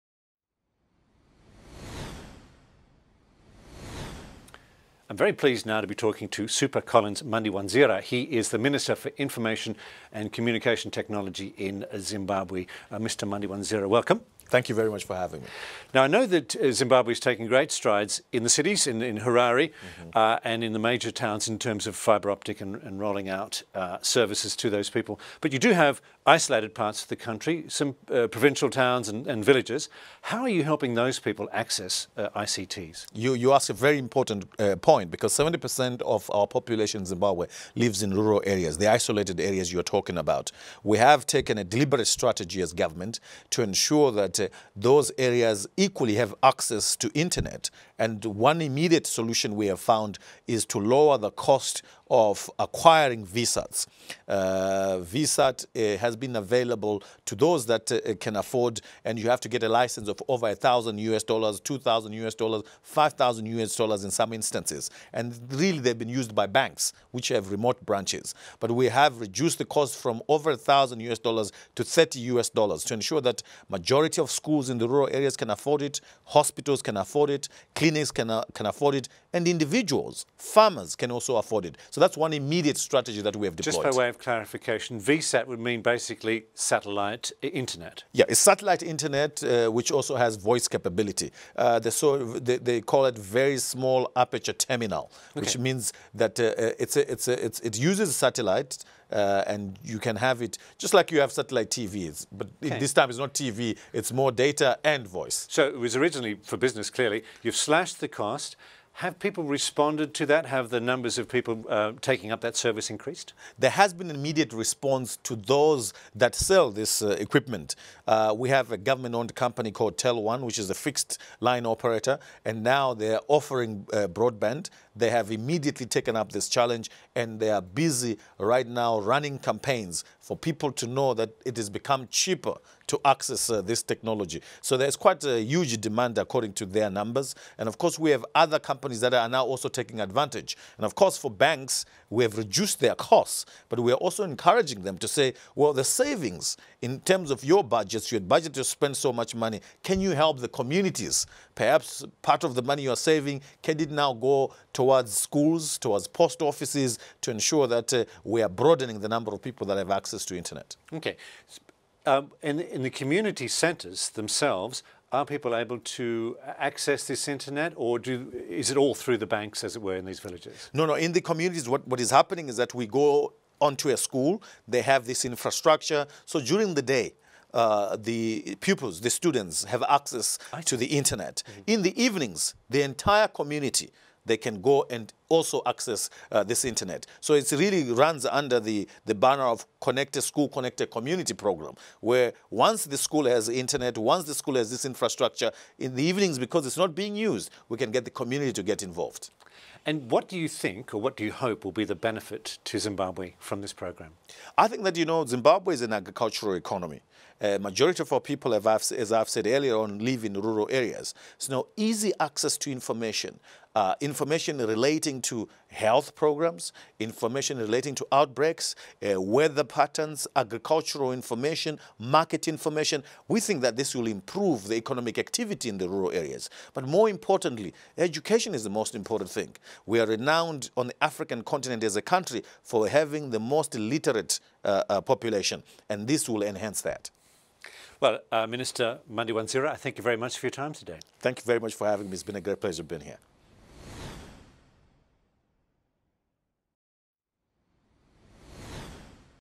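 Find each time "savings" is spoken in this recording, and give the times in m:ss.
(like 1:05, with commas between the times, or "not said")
2:25, 2:32.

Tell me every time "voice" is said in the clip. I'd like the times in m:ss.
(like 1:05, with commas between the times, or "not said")
1:30, 1:45.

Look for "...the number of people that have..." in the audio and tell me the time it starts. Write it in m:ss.
2:38.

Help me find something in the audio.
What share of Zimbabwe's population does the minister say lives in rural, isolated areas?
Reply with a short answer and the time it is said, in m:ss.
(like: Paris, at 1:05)
70%, at 0:35.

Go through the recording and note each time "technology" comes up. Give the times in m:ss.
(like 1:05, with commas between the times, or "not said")
0:10, 2:13.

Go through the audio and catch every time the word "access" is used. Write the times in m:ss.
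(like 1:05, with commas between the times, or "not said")
0:31, 0:46, 2:13, 2:39, 2:46, 2:59, 3:05, 3:32.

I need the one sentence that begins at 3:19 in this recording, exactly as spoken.
And what do you think, or what do you hope, will be the benefit to Zimbabwe from this program?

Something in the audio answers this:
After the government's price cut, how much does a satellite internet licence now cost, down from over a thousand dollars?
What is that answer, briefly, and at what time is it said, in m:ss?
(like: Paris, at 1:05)
30 US dollars, at 1:11.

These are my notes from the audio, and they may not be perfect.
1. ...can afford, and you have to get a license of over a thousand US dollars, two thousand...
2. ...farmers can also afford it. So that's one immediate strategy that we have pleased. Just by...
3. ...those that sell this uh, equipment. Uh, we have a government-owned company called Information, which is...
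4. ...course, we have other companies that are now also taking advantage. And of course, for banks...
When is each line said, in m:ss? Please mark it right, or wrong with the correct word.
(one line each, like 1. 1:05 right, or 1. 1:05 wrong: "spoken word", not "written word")
1. 0:58 right
2. 1:20 wrong: "deployed", not "pleased"
3. 1:55 wrong: "TelOne", not "Information"
4. 2:17 right.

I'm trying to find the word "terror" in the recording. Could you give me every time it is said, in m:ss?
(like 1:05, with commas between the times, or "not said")
not said.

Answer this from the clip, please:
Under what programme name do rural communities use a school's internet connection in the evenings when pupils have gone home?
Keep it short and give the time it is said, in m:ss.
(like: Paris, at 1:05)
Connected School, Connected Community, at 3:09.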